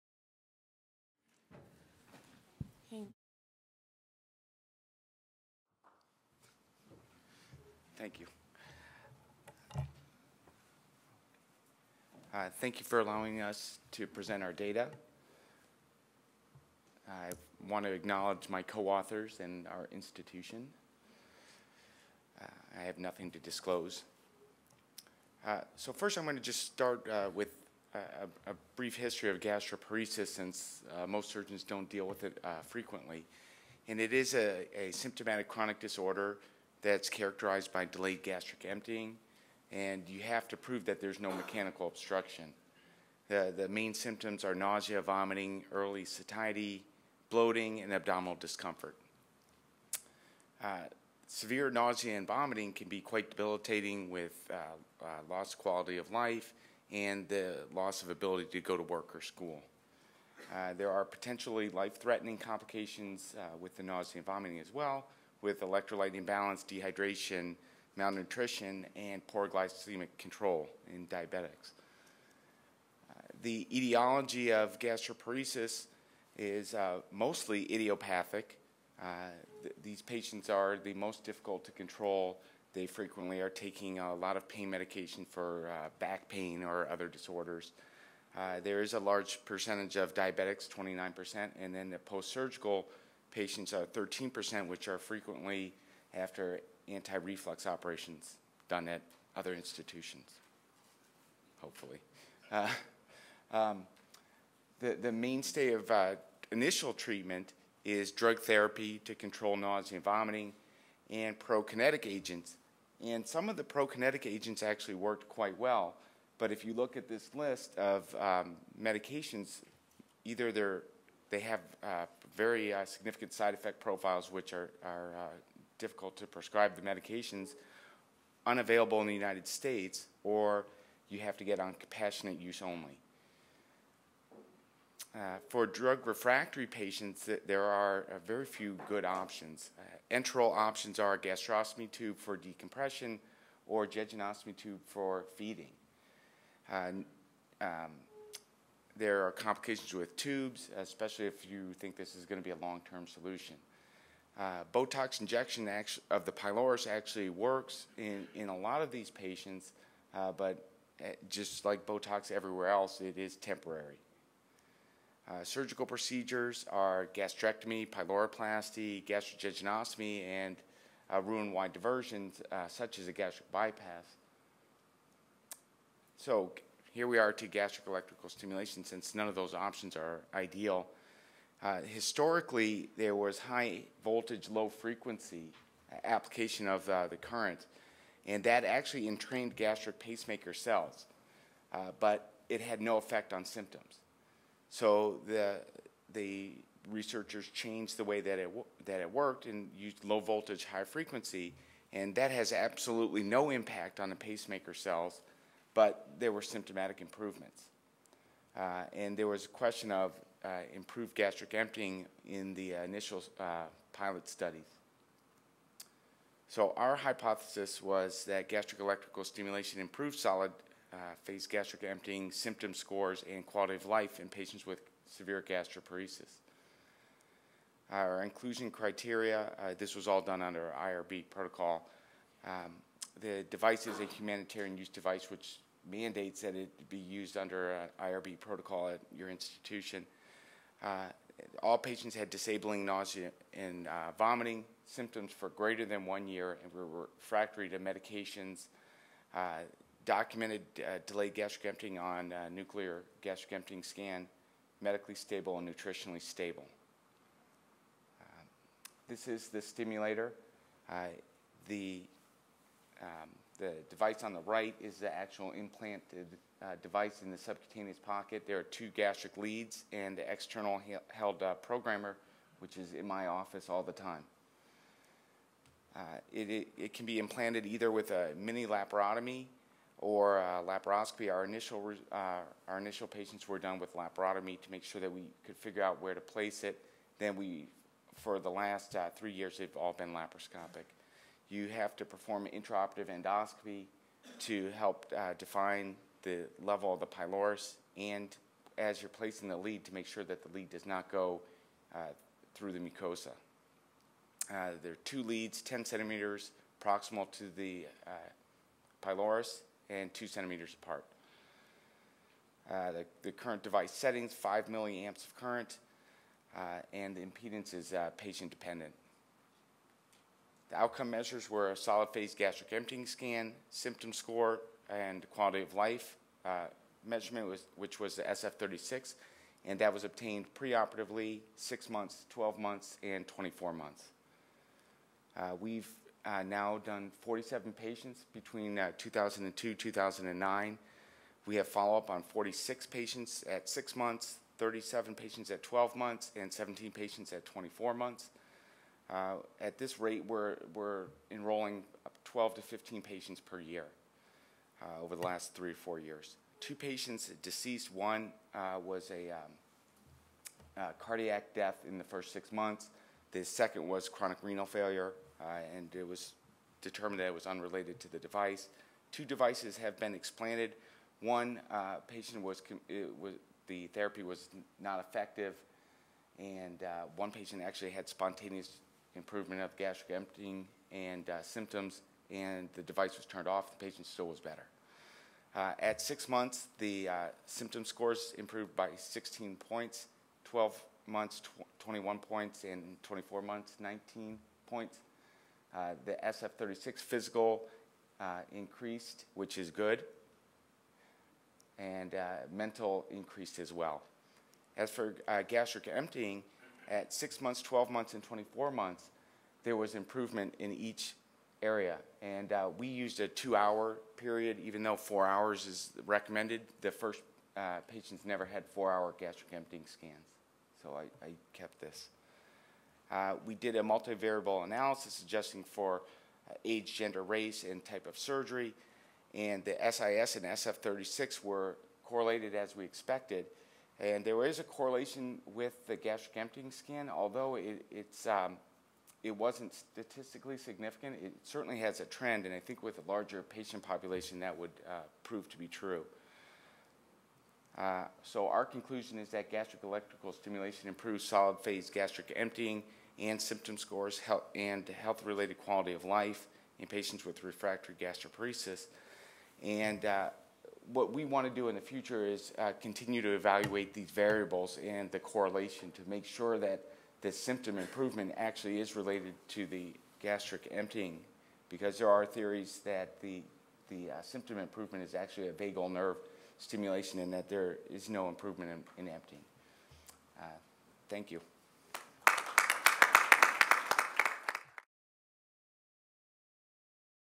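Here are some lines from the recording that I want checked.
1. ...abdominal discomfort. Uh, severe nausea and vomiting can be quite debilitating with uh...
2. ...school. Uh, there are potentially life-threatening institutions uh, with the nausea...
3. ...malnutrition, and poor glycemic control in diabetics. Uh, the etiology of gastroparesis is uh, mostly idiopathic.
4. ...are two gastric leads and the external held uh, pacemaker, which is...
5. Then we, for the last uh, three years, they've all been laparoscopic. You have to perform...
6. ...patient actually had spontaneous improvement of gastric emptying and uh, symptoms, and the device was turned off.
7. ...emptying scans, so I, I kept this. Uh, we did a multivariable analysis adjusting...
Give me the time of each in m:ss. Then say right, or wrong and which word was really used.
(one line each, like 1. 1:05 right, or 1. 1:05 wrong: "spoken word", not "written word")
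1. 0:47 right
2. 0:59 wrong: "complications", not "institutions"
3. 1:07 right
4. 4:28 wrong: "programmer", not "pacemaker"
5. 4:47 right
6. 6:17 right
7. 6:59 right.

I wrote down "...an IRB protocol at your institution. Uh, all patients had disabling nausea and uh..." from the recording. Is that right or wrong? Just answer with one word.
right.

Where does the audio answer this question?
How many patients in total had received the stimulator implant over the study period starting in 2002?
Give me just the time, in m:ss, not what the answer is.
5:37.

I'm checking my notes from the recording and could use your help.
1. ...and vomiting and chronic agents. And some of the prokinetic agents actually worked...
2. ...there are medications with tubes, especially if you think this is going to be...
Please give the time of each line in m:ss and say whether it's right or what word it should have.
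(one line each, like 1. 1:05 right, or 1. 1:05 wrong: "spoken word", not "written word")
1. 1:49 wrong: "prokinetic", not "chronic"
2. 2:29 wrong: "complications", not "medications".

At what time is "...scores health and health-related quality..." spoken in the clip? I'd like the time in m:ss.
7:33.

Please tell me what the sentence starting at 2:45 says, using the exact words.
Uh, surgical procedures are gastrectomy, pyloroplasty, gastrojejunostomy, and uh, Roux-en-Y diversions, uh, such as a gastric bypass.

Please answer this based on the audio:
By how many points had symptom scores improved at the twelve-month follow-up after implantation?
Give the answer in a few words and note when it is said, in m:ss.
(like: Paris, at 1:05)
21 points, at 6:31.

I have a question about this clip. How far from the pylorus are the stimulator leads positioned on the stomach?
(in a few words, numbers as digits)
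10 centimeters.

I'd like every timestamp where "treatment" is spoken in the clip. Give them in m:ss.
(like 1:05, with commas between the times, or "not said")
1:46.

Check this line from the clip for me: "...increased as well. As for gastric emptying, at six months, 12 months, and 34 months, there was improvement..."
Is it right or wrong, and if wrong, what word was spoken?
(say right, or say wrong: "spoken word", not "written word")
wrong: "24", not "34".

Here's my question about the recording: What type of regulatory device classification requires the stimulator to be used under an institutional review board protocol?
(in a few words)
humanitarian use device.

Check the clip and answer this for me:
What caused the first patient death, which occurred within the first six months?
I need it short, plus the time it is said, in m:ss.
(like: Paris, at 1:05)
cardiac death, at 6:00.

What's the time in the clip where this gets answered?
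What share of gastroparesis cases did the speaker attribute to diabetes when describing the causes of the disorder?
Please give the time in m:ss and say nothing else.
1:30.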